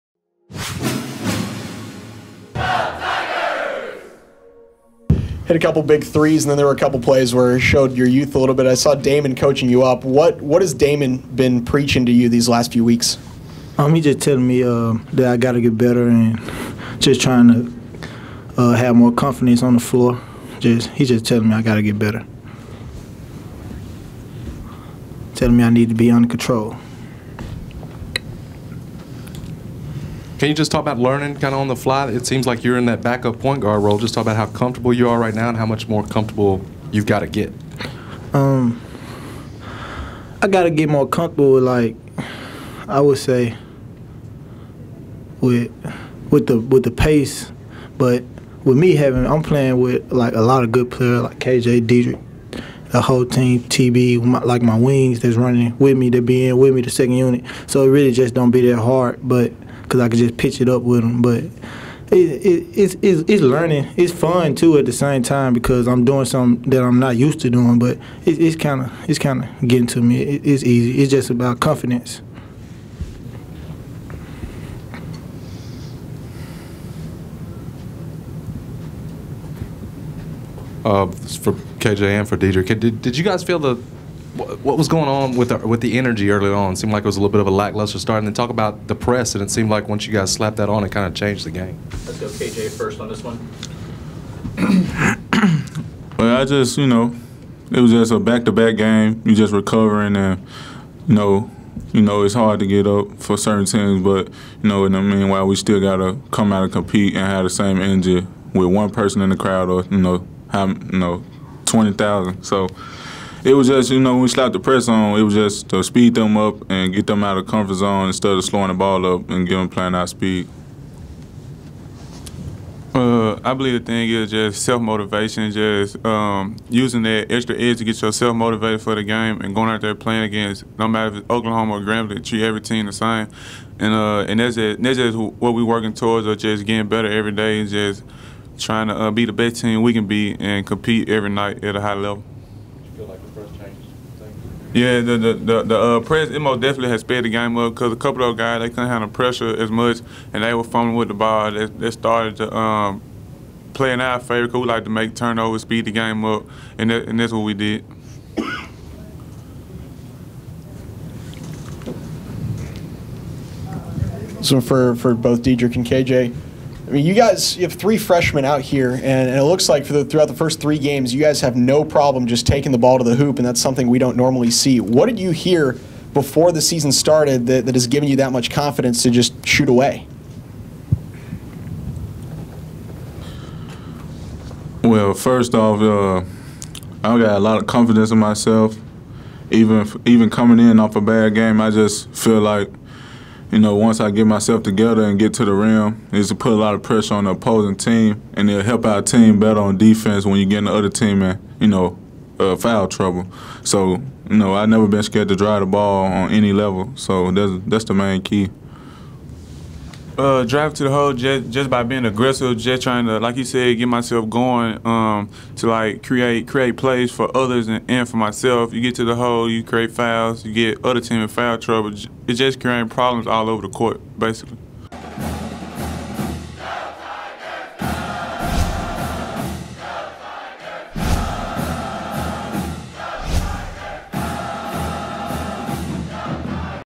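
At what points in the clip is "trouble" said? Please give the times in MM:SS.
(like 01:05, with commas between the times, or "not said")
03:22, 03:41.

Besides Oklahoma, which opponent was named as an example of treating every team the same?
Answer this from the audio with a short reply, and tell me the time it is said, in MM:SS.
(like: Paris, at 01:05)
Grambling, at 02:11.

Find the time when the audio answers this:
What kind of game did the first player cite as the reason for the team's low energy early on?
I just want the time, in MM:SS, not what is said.
01:38.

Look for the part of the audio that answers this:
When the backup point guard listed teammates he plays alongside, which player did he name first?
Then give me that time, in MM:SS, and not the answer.
00:51.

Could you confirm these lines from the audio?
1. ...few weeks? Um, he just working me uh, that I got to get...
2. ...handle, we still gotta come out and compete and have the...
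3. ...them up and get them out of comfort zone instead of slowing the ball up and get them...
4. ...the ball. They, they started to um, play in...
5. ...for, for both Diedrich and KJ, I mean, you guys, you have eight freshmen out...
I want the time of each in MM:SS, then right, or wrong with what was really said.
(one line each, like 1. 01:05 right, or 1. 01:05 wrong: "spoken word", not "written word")
1. 00:12 wrong: "telling", not "working"
2. 01:45 wrong: "meanwhile", not "handle"
3. 01:56 right
4. 02:31 right
5. 02:44 wrong: "three", not "eight".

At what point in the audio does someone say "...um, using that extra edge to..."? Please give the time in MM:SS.
02:06.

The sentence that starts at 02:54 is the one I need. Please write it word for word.
What did you hear before the season started that, that has given you that much confidence to just shoot away?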